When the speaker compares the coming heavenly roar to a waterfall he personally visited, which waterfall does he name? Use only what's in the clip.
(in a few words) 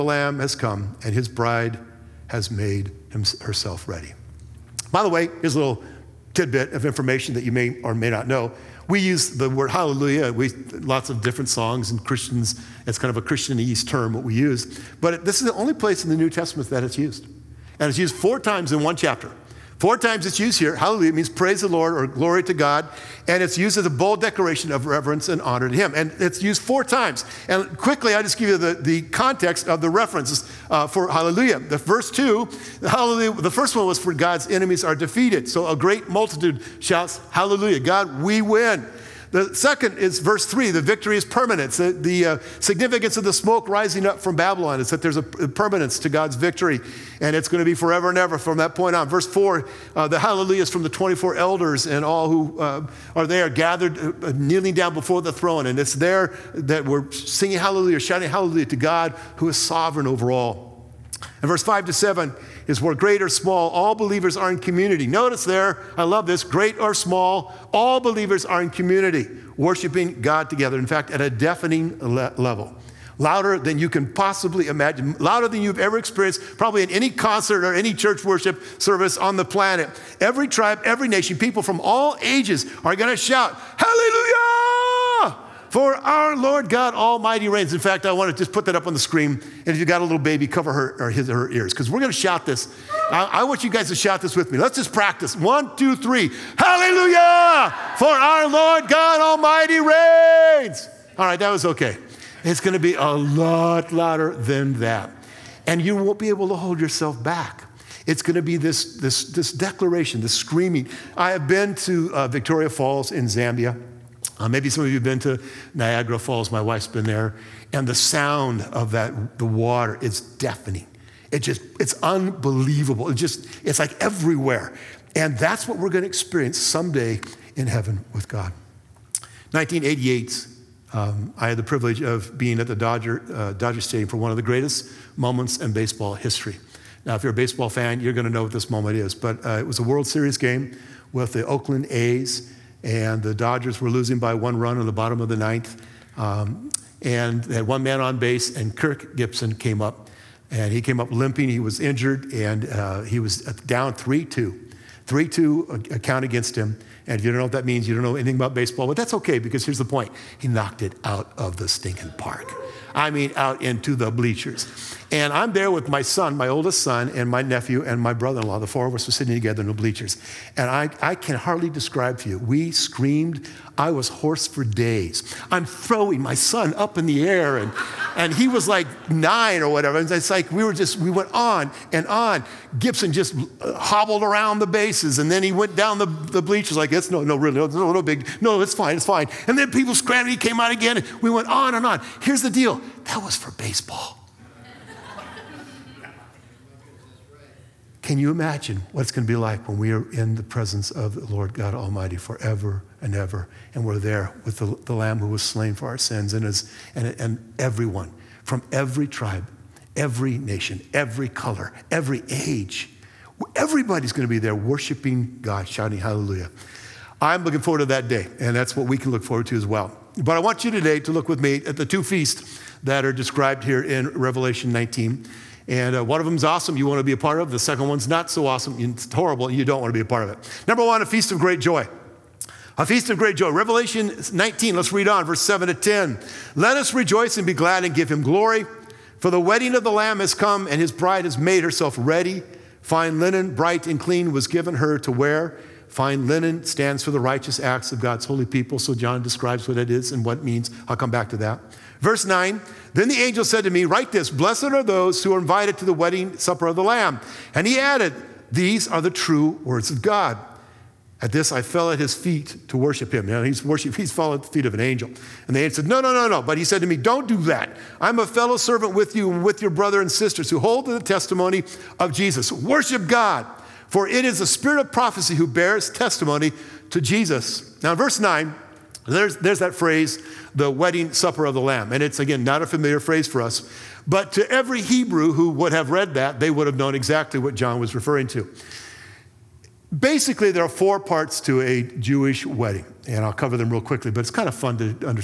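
Victoria Falls.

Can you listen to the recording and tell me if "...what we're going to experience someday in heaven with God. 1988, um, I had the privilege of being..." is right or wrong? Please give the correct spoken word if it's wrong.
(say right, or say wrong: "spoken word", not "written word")
right.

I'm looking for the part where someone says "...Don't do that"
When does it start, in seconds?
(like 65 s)
266 s.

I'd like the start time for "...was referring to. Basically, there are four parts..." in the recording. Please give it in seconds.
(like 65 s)
287 s.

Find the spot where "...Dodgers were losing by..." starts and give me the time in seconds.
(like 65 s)
143 s.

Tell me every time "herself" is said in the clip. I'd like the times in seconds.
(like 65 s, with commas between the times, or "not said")
3 s, 241 s.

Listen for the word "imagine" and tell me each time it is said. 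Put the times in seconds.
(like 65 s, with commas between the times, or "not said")
74 s, 198 s.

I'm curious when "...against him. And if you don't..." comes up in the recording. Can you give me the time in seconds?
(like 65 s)
156 s.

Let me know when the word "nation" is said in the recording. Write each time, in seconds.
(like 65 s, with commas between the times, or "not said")
81 s, 210 s.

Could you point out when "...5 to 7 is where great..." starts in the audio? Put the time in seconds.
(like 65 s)
61 s.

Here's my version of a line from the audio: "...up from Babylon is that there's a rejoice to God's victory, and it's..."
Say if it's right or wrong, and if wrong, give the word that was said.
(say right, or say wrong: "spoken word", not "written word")
wrong: "permanence", not "rejoice".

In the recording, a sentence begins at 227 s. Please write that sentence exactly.
The second one's not so awesome, it's horrible, you don't want to be a part of it.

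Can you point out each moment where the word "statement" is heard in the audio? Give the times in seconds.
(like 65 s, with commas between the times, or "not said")
not said.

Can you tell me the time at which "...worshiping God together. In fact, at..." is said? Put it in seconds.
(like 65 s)
69 s.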